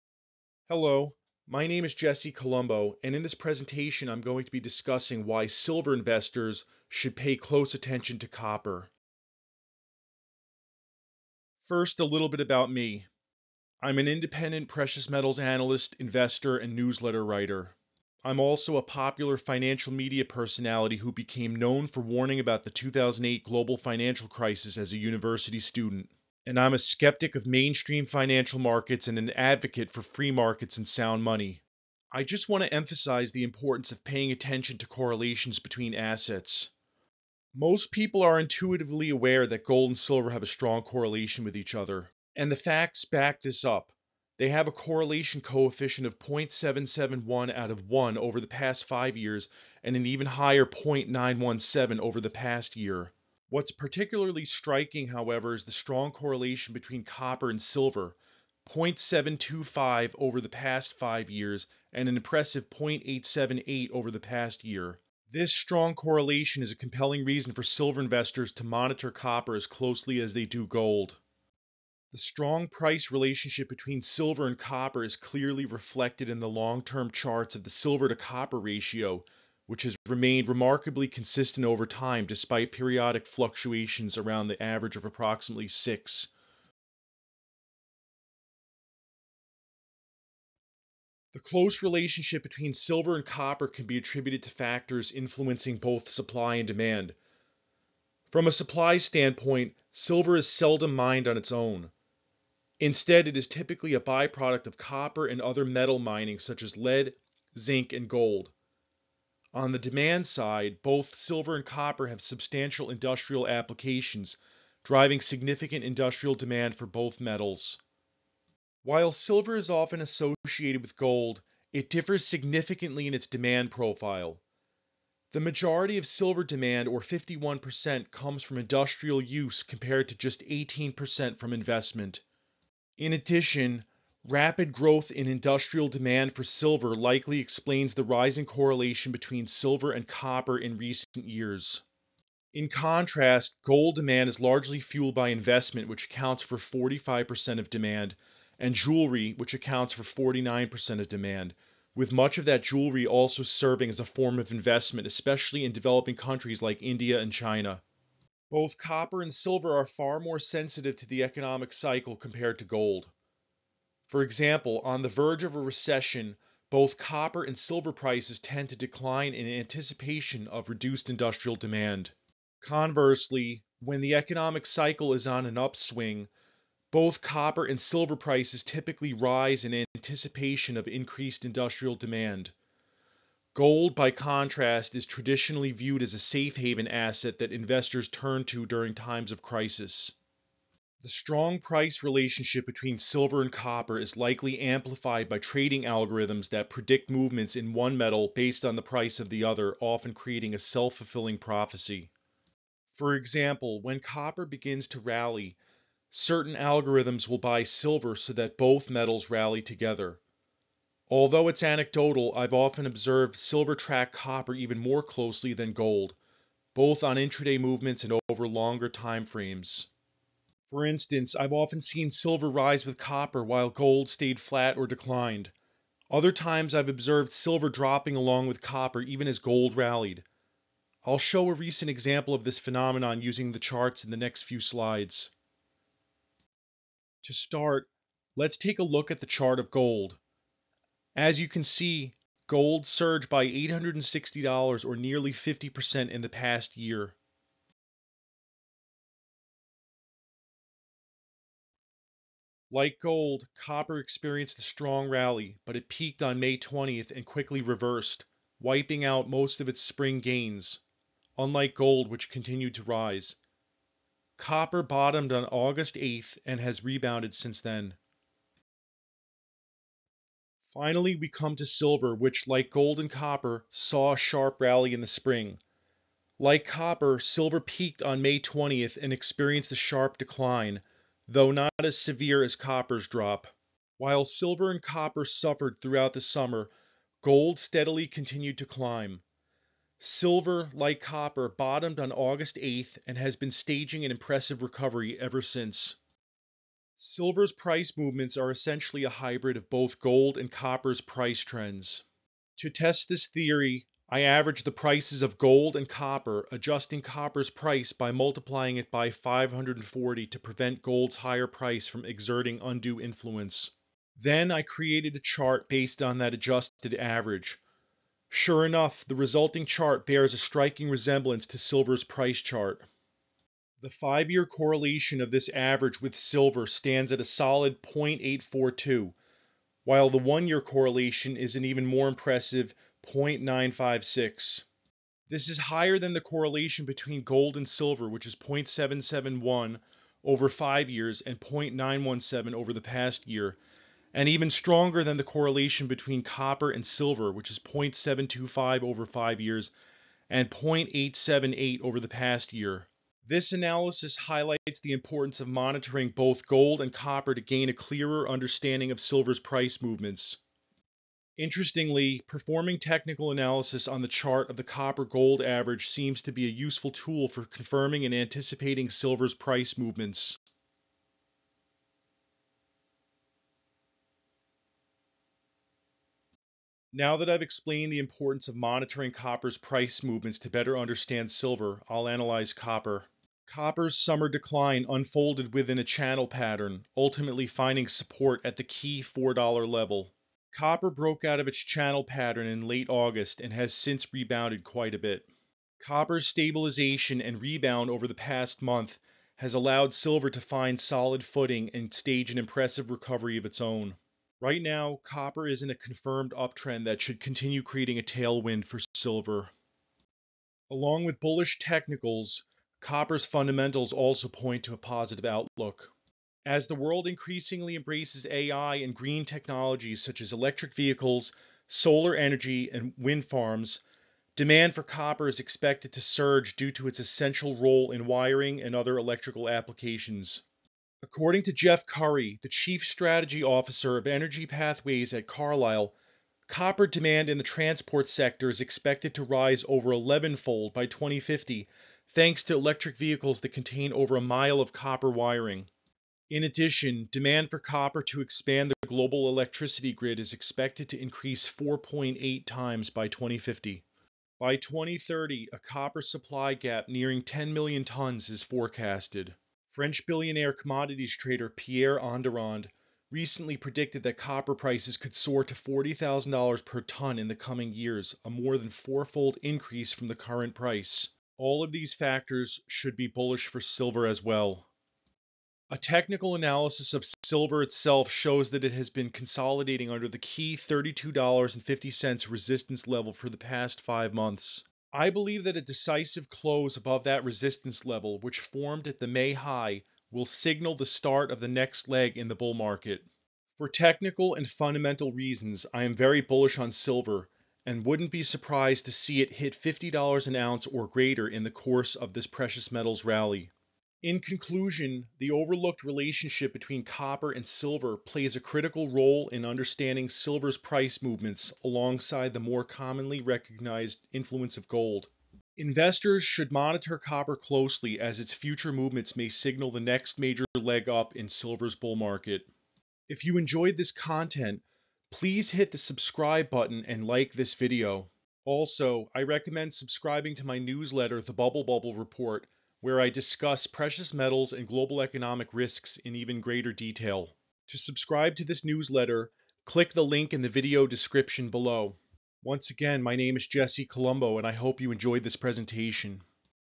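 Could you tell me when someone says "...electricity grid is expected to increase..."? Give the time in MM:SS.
07:29.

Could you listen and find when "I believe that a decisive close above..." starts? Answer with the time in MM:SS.
08:04.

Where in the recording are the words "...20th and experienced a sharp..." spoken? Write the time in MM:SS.
04:38.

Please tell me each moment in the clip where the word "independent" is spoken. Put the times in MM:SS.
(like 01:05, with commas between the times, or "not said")
00:14.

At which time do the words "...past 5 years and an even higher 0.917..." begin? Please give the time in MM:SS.
00:48.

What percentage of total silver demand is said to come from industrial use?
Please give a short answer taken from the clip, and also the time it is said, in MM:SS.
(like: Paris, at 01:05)
51%, at 02:07.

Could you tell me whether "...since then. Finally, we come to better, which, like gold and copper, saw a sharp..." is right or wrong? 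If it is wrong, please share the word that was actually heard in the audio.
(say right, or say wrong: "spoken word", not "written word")
wrong: "silver", not "better".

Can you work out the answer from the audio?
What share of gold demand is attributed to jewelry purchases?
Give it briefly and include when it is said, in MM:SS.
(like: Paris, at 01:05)
49%, at 02:30.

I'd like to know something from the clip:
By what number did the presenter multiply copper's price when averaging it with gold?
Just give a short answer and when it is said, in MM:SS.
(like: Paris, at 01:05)
540, at 05:09.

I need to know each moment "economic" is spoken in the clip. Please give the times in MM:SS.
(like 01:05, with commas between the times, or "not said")
02:41, 02:54, 08:55.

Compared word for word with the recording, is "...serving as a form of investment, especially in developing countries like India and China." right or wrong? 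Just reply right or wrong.
right.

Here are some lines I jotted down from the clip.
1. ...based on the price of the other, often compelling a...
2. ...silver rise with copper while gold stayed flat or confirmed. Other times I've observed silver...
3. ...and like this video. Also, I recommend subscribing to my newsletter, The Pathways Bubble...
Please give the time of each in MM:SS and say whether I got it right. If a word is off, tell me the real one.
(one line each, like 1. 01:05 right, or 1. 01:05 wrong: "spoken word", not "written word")
1. 03:18 wrong: "creating", not "compelling"
2. 03:42 wrong: "declined", not "confirmed"
3. 08:46 wrong: "Bubble", not "Pathways".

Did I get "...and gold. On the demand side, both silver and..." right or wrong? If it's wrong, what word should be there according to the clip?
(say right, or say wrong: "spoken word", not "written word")
right.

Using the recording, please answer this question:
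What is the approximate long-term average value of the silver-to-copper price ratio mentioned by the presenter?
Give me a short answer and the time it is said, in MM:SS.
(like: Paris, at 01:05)
6, at 01:25.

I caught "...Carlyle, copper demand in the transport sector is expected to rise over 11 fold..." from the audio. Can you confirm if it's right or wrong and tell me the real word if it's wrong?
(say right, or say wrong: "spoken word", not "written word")
right.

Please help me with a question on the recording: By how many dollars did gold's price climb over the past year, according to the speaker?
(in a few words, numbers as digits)
$860.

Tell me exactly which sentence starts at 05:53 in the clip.
This analysis highlights the importance of monitoring both gold and copper to gain a clearer understanding of silver's price movements.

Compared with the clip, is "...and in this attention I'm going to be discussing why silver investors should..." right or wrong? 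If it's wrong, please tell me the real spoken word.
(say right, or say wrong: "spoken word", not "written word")
wrong: "presentation", not "attention".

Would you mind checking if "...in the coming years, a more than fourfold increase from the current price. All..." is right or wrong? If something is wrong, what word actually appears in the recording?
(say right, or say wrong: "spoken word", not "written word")
right.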